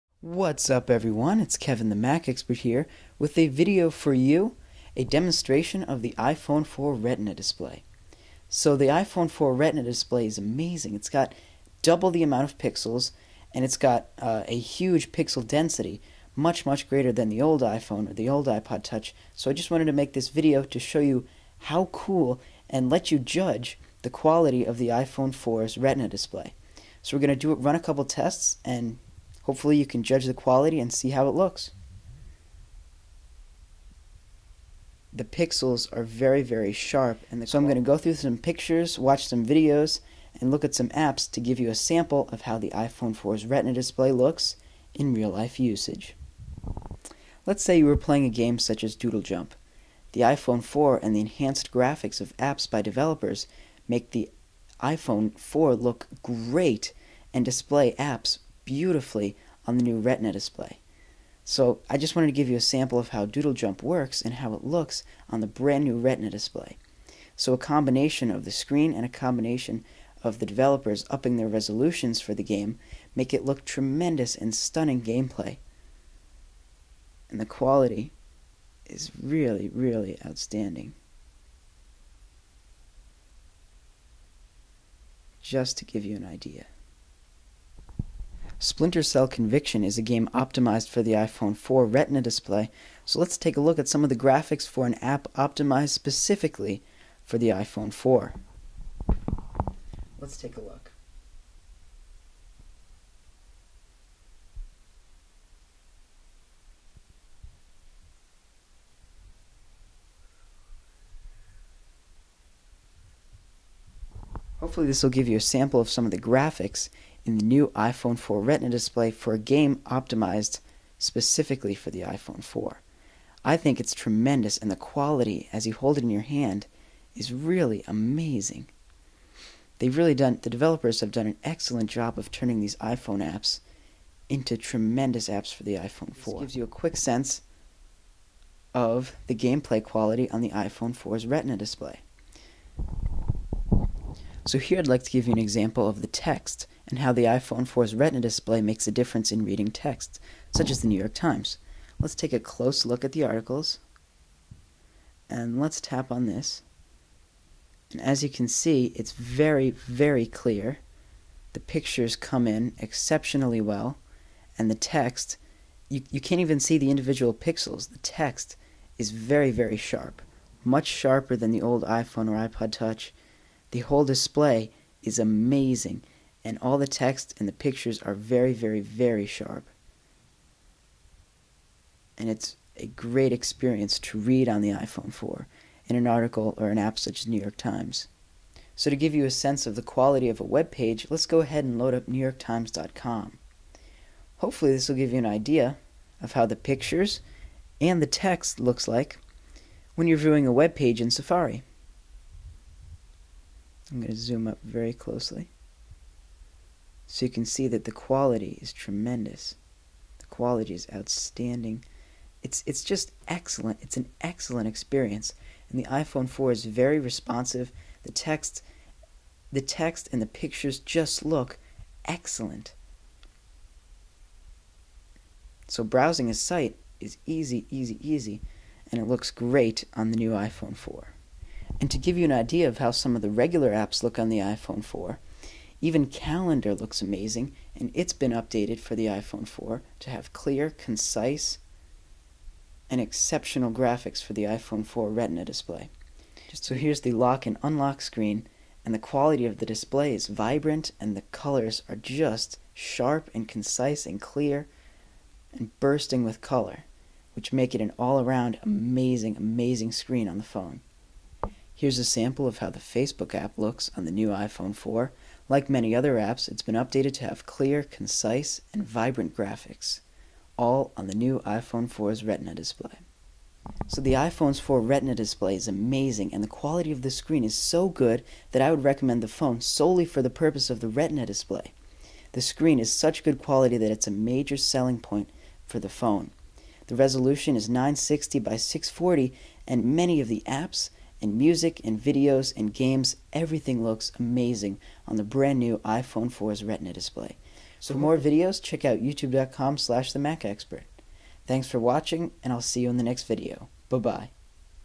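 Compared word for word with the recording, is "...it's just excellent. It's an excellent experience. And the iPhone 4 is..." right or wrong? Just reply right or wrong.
right.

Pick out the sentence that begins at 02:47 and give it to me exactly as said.
The text is very, very sharp, much sharper than the old iPhone or iPod Touch.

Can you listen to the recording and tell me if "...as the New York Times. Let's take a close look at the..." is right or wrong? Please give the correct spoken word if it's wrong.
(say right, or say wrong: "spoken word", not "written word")
right.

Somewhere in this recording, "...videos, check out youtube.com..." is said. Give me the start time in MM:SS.
04:58.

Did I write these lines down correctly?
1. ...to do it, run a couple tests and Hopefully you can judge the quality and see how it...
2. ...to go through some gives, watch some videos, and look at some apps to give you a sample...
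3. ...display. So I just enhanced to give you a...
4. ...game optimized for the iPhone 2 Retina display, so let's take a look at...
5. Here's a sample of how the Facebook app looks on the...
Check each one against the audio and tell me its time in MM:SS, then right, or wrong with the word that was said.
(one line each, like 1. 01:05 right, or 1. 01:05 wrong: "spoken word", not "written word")
1. 00:27 right
2. 00:37 wrong: "pictures", not "gives"
3. 01:00 wrong: "wanted", not "enhanced"
4. 01:30 wrong: "4", not "2"
5. 04:21 right.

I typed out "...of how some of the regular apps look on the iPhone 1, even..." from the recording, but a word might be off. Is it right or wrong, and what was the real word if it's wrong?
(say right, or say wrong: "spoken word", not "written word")
wrong: "4", not "1".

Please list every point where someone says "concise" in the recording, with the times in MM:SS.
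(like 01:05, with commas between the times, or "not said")
04:00, 04:13, 04:27.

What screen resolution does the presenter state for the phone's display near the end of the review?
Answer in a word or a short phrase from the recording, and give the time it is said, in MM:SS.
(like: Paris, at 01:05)
960 by 640, at 04:47.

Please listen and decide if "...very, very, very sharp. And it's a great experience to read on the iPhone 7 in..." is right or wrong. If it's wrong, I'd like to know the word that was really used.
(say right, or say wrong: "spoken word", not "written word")
wrong: "4", not "7".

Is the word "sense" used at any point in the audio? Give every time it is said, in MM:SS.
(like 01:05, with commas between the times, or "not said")
02:16, 03:09.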